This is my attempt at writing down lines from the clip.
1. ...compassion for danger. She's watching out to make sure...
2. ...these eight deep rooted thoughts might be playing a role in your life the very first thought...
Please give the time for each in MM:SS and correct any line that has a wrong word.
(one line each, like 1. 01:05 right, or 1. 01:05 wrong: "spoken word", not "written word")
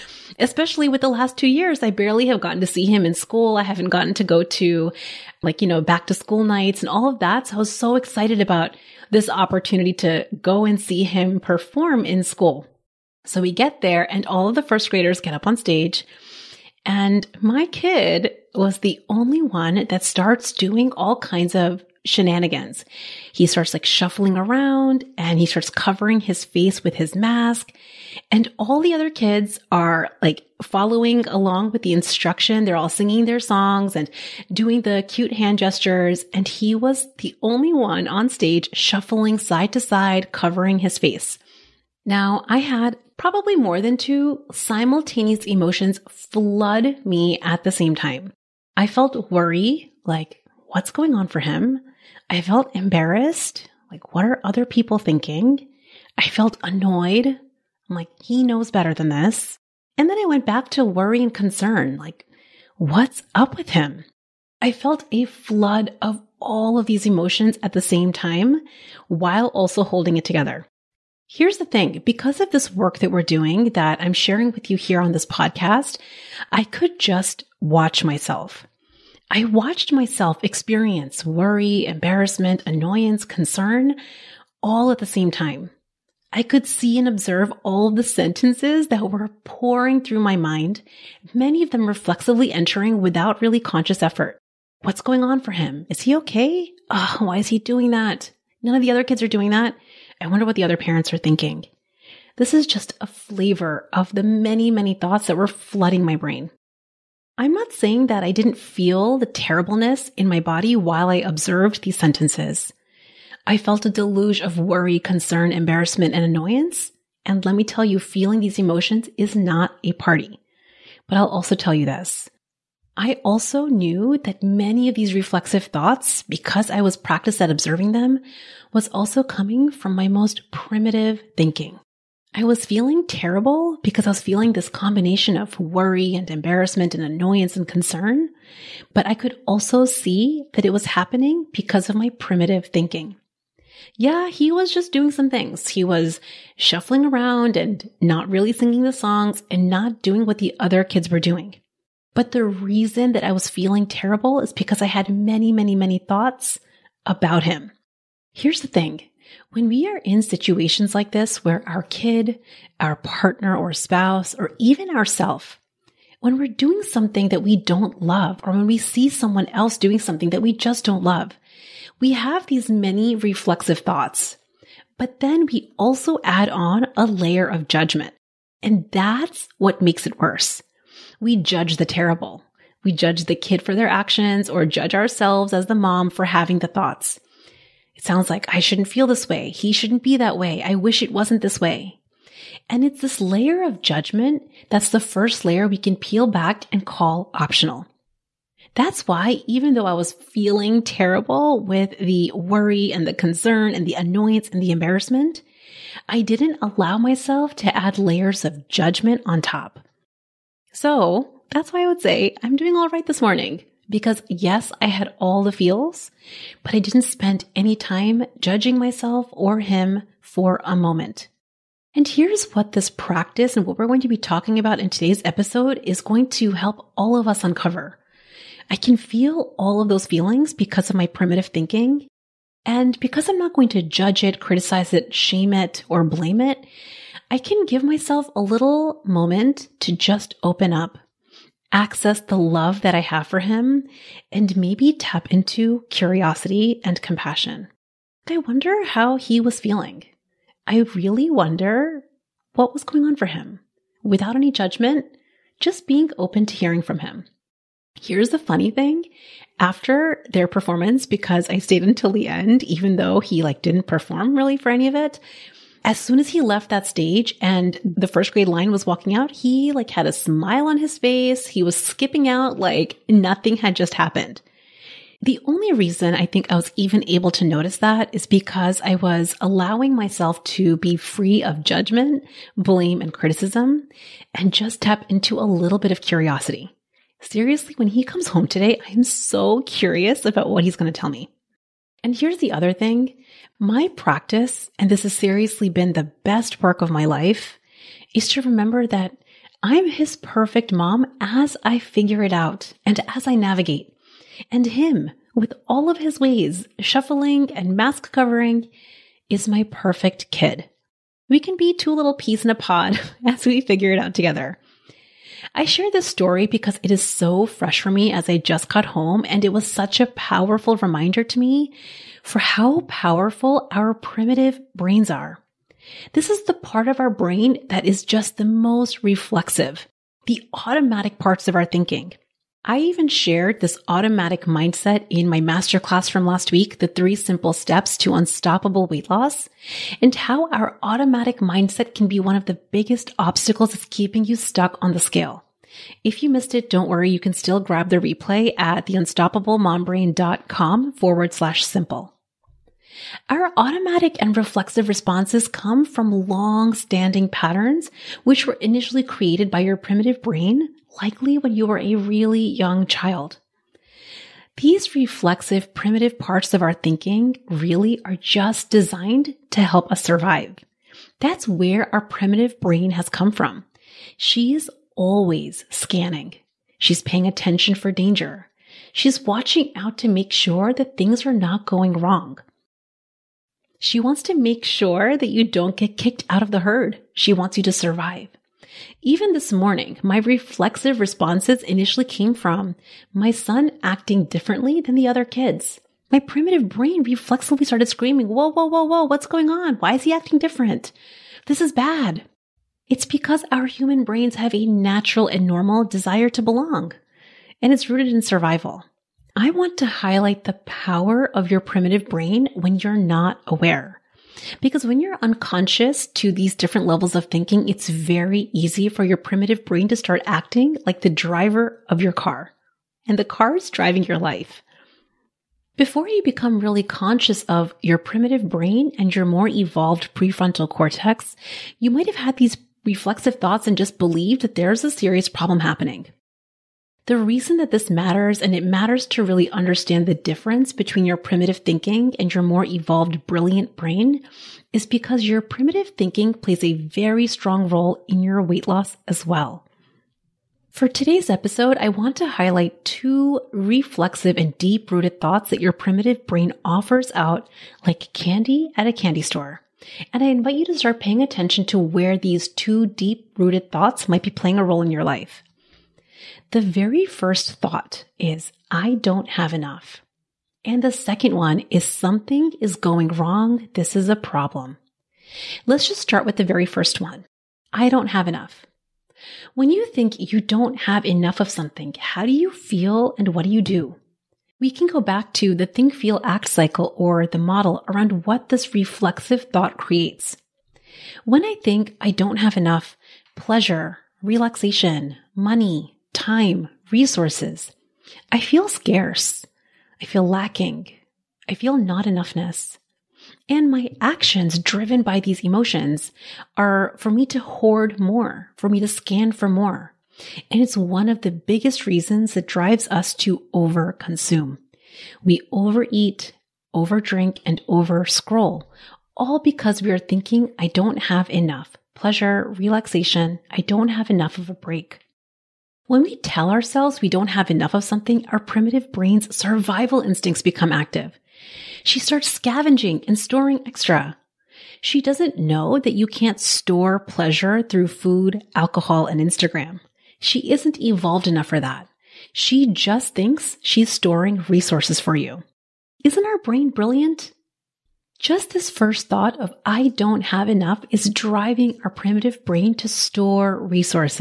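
1. 06:17 wrong: "attention", not "compassion"
2. 07:42 wrong: "two", not "eight".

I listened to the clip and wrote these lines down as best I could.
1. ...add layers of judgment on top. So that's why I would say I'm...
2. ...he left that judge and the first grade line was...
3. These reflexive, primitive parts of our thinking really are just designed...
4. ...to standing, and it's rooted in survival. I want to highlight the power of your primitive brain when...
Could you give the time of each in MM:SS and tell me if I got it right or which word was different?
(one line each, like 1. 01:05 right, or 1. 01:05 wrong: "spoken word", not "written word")
1. 03:27 right
2. 04:26 wrong: "stage", not "judge"
3. 06:04 right
4. 06:46 wrong: "belong", not "standing".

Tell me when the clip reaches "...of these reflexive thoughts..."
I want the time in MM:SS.
02:04.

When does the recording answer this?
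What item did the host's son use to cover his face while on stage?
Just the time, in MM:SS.
00:26.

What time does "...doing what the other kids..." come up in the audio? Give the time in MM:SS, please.
02:30.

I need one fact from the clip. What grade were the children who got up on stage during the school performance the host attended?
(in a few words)
First grade.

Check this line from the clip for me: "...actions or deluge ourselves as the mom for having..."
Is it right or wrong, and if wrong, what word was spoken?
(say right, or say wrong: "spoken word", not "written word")
wrong: "judge", not "deluge".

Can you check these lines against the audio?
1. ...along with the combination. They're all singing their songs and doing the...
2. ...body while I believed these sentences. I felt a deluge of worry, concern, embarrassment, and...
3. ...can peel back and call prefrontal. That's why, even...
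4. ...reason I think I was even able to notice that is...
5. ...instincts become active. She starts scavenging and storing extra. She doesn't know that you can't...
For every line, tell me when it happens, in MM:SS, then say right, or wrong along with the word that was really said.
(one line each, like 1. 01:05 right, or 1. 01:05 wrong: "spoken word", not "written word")
1. 00:31 wrong: "instruction", not "combination"
2. 01:50 wrong: "observed", not "believed"
3. 03:15 wrong: "optional", not "prefrontal"
4. 04:35 right
5. 08:50 right.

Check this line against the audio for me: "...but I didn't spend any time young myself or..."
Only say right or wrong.
wrong.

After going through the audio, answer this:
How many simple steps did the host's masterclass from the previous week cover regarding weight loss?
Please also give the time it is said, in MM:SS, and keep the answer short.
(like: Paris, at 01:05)
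3, at 05:36.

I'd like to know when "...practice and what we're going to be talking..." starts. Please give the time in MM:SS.
03:42.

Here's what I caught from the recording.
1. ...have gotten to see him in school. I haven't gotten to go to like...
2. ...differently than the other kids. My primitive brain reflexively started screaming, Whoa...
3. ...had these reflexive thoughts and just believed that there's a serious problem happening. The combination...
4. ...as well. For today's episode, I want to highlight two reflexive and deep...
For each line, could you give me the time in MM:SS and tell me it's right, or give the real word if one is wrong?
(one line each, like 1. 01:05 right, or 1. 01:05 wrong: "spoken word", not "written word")
1. 00:02 right
2. 06:34 right
3. 07:12 wrong: "reason", not "combination"
4. 07:29 right.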